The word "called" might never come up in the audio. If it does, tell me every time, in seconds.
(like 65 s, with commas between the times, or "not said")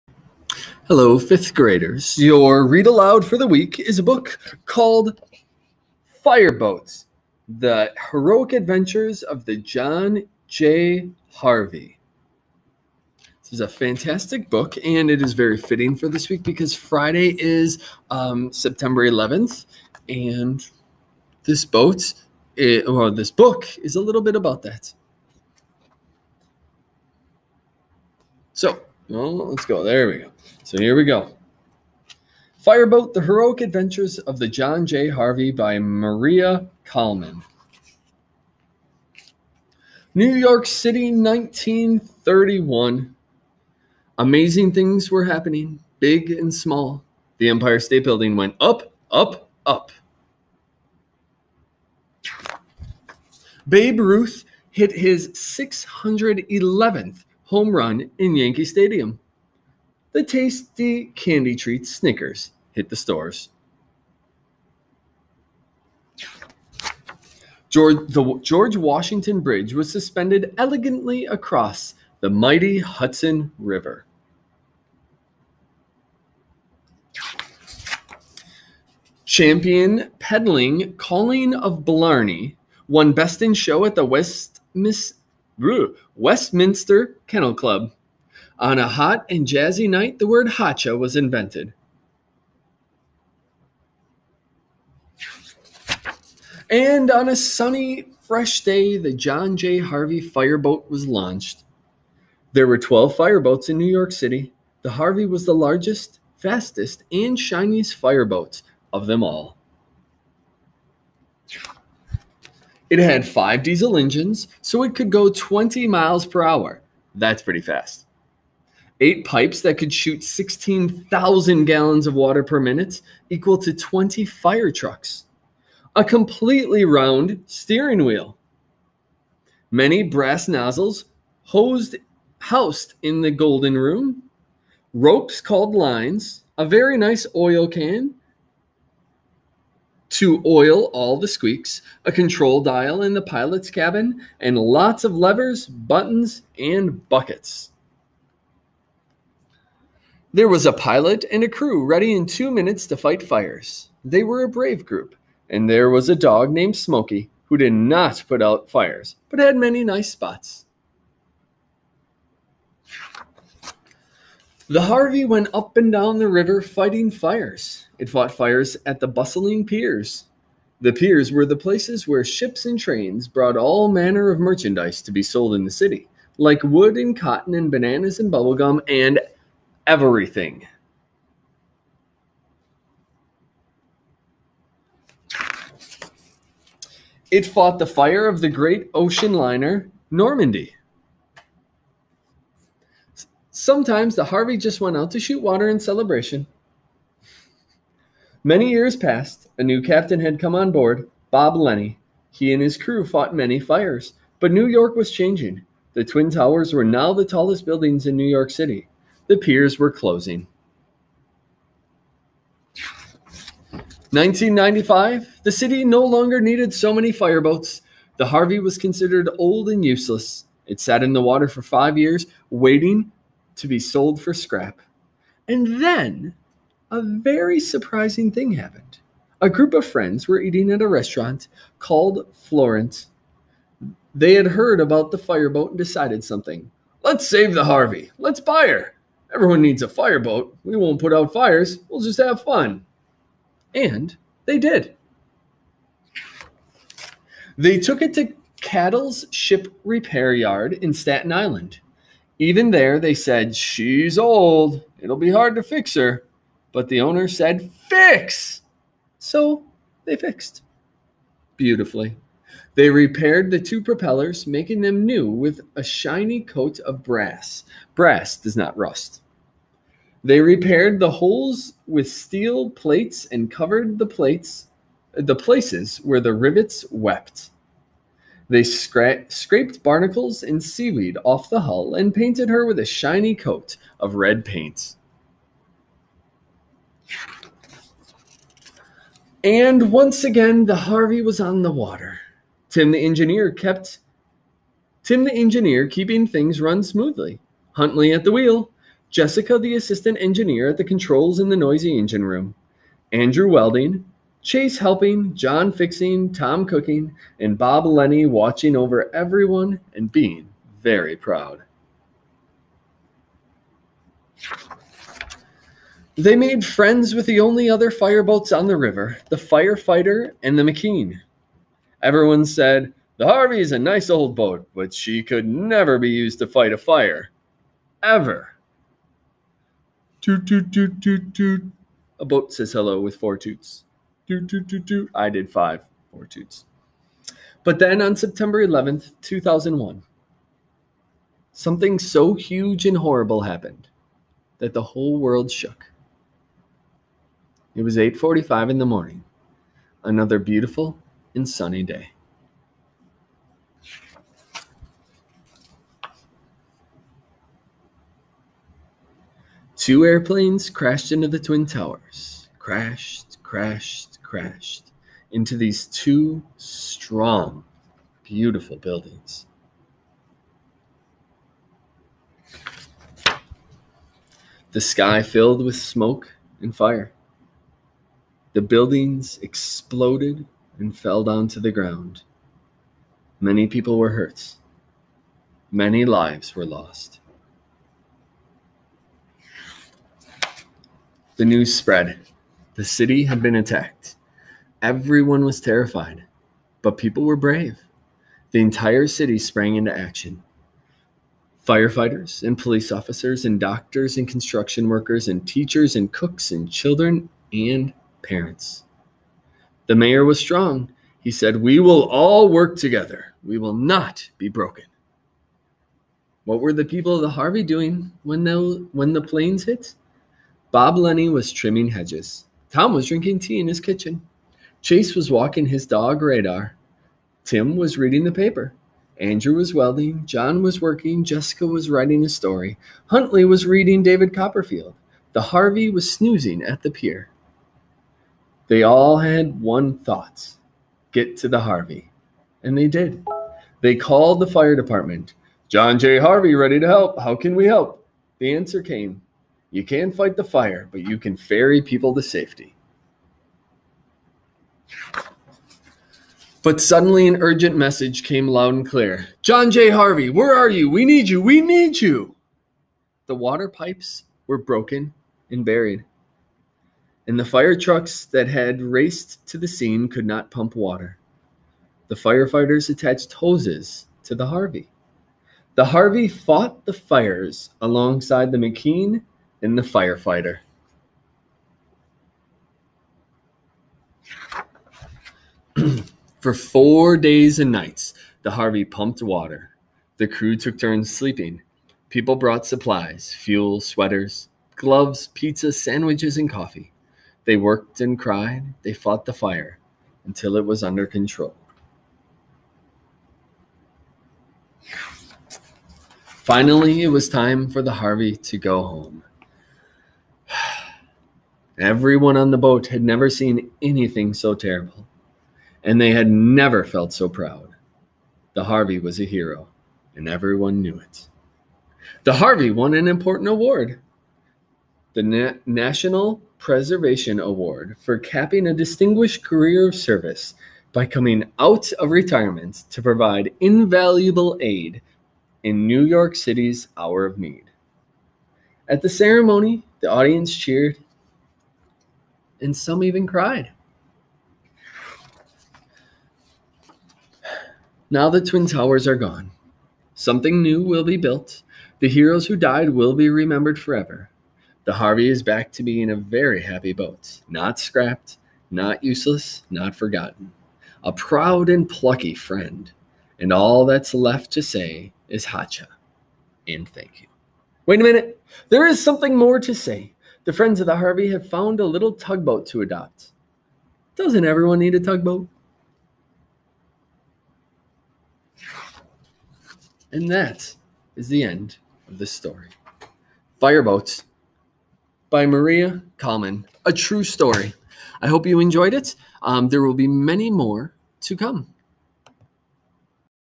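4 s, 135 s, 231 s, 443 s.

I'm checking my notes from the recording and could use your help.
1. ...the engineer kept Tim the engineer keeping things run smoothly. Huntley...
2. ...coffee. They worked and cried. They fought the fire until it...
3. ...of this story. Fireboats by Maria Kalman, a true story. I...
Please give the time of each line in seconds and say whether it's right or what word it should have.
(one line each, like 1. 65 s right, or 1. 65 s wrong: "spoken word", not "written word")
1. 292 s right
2. 496 s right
3. 582 s right.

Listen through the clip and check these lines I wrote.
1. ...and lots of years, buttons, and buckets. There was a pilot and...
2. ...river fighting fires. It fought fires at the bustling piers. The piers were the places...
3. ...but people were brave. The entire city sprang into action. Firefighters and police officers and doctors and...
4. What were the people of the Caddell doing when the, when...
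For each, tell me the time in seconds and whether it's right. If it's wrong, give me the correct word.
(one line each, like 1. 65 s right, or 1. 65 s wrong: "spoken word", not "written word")
1. 144 s wrong: "levers", not "years"
2. 166 s right
3. 396 s right
4. 416 s wrong: "Harvey", not "Caddell".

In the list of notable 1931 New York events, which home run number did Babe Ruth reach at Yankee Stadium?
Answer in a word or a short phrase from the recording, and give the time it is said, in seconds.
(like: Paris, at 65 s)
611th, at 55 s.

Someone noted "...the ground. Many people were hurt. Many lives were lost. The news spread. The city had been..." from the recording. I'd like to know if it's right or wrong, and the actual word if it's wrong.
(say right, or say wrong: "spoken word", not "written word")
right.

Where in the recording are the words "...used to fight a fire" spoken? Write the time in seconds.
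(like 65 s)
326 s.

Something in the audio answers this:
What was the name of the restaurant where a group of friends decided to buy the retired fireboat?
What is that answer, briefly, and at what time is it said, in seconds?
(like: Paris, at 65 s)
Florence, at 232 s.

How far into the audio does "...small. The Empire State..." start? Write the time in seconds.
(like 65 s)
46 s.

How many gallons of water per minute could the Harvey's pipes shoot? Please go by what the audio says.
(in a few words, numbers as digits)
16,000.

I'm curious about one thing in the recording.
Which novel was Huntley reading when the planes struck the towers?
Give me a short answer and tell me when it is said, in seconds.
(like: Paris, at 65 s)
David Copperfield, at 434 s.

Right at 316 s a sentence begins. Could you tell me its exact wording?
They made friends with the only other fireboats on the river, the firefighter and the McKean.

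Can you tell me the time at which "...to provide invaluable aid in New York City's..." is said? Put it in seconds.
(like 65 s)
532 s.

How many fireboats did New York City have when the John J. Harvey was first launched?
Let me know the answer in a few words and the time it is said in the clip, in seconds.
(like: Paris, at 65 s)
12, at 102 s.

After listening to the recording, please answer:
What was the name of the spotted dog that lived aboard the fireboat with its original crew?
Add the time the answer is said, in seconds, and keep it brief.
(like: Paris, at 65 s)
Smoky, at 156 s.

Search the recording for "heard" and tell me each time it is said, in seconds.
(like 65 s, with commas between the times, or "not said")
234 s.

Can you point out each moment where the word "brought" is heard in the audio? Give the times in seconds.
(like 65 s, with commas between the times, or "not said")
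173 s, 492 s.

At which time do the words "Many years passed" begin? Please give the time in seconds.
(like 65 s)
198 s.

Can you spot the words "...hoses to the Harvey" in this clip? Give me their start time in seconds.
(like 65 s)
473 s.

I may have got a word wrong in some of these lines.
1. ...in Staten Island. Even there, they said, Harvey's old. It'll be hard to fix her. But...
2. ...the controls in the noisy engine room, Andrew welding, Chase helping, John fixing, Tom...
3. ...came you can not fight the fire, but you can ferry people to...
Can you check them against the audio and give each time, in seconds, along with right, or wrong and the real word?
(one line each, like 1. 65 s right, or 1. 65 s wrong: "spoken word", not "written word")
1. 250 s wrong: "She", not "Harvey"
2. 300 s right
3. 448 s right.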